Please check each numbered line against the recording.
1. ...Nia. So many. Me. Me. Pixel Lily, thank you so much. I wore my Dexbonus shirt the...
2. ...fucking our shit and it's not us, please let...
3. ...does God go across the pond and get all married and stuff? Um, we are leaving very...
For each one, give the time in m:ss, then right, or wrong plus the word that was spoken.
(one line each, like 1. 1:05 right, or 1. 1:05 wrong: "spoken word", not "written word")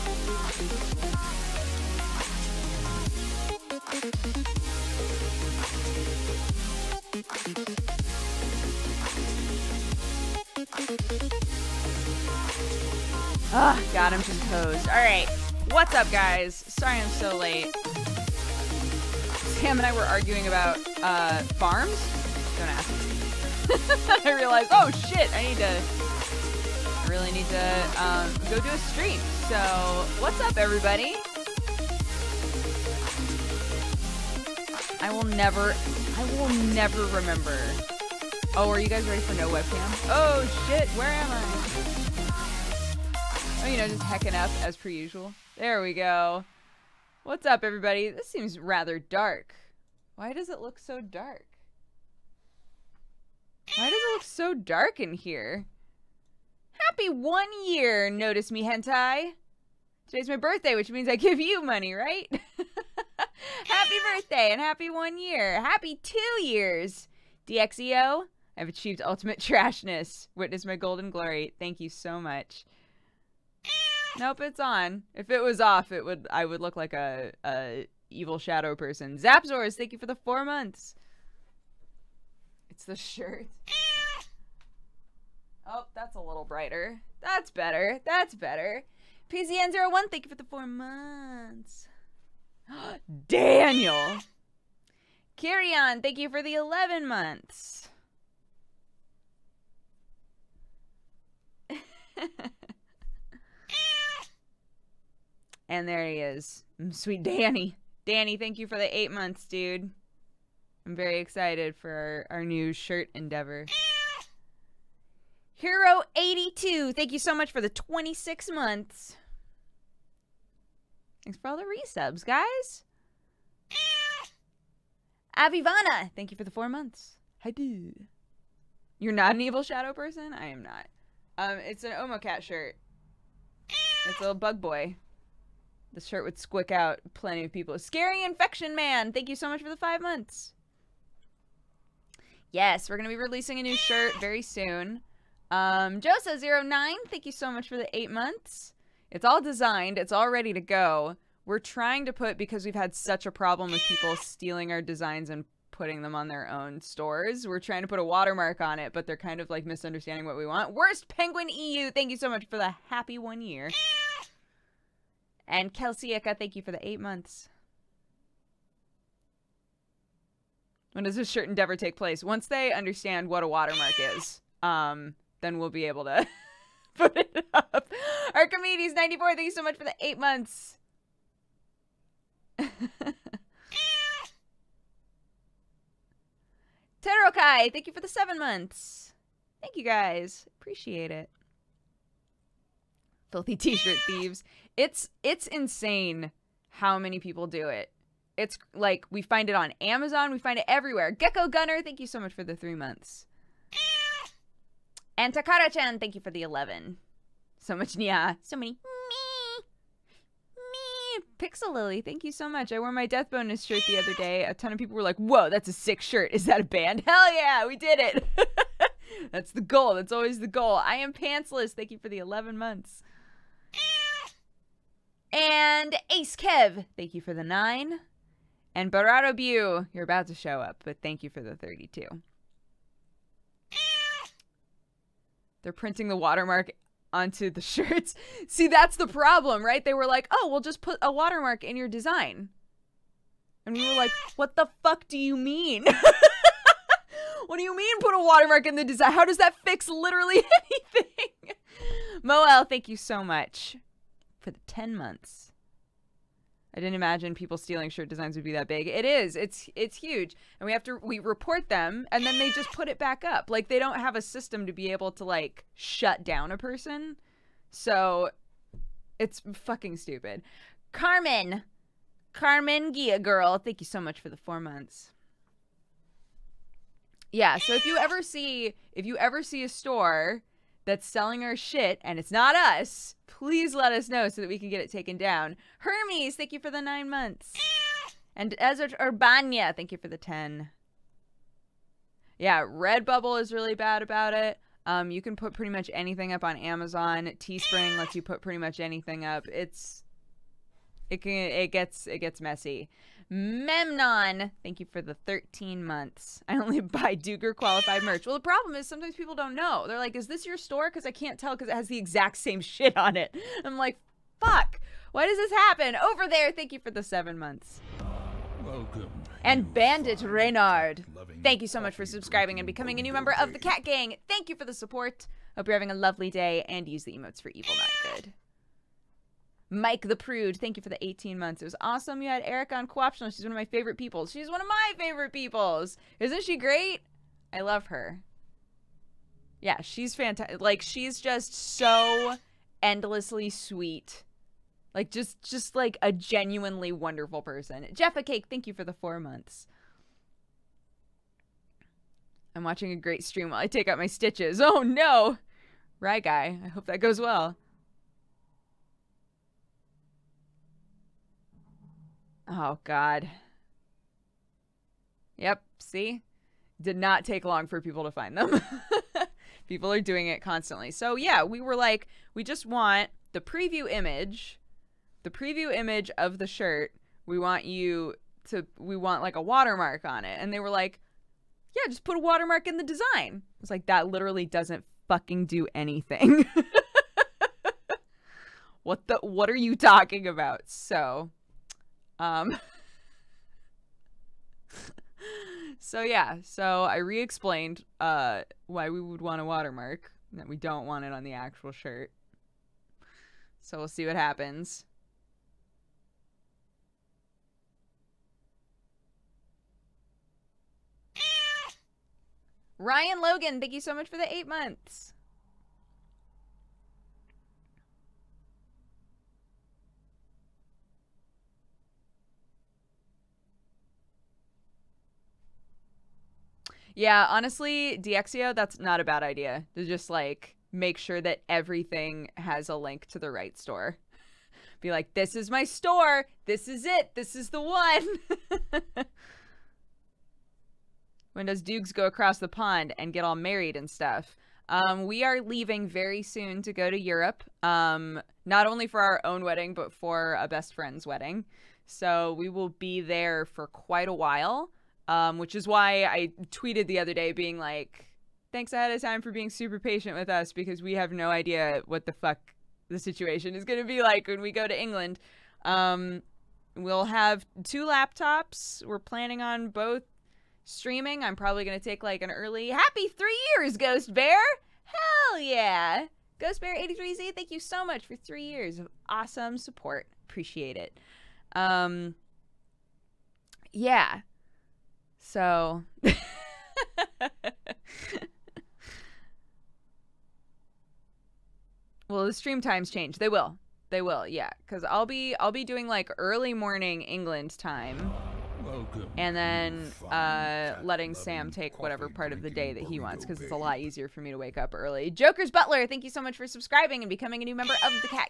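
1. 3:27 right
2. 4:41 wrong: "selling", not "fucking"
3. 7:21 wrong: "Dukes", not "God".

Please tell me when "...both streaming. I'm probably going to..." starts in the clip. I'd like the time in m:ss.
7:49.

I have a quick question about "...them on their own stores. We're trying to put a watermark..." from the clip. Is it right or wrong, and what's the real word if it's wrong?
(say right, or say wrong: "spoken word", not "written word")
right.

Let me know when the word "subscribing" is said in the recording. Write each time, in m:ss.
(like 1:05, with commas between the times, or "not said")
5:22, 8:26.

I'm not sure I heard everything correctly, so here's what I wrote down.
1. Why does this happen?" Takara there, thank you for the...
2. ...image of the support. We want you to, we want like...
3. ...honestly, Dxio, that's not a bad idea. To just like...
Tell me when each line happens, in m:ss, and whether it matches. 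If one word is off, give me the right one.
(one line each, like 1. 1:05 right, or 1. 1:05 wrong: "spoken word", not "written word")
1. 5:15 wrong: "Over", not "Takara"
2. 6:15 wrong: "shirt", not "support"
3. 7:07 right.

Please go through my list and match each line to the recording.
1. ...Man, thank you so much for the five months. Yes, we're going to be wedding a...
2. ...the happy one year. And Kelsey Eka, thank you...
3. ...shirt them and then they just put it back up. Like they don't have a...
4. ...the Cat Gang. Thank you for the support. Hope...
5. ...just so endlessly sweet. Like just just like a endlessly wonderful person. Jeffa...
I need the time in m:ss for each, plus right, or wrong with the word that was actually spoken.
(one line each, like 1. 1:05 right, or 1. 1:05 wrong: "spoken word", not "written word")
1. 2:18 wrong: "releasing", not "wedding"
2. 2:42 right
3. 4:21 wrong: "report", not "shirt"
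4. 5:23 right
5. 5:41 wrong: "genuinely", not "endlessly".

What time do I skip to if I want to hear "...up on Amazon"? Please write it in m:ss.
4:56.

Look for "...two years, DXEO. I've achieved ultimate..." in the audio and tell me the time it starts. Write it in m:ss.
1:06.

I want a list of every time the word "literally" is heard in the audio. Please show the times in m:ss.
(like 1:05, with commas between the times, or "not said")
4:09, 6:24.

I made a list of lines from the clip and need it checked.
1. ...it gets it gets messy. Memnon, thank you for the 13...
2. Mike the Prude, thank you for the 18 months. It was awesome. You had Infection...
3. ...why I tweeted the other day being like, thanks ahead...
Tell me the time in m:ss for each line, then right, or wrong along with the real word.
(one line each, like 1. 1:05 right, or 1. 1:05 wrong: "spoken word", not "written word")
1. 5:01 right
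2. 5:29 wrong: "Eric", not "Infection"
3. 7:35 right.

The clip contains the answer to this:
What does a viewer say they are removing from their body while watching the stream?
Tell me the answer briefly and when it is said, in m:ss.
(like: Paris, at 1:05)
Stitches, at 5:54.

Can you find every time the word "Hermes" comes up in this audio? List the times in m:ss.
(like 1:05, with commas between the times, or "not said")
4:45.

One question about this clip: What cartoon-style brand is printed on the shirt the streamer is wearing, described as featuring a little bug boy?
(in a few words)
Omo Cat.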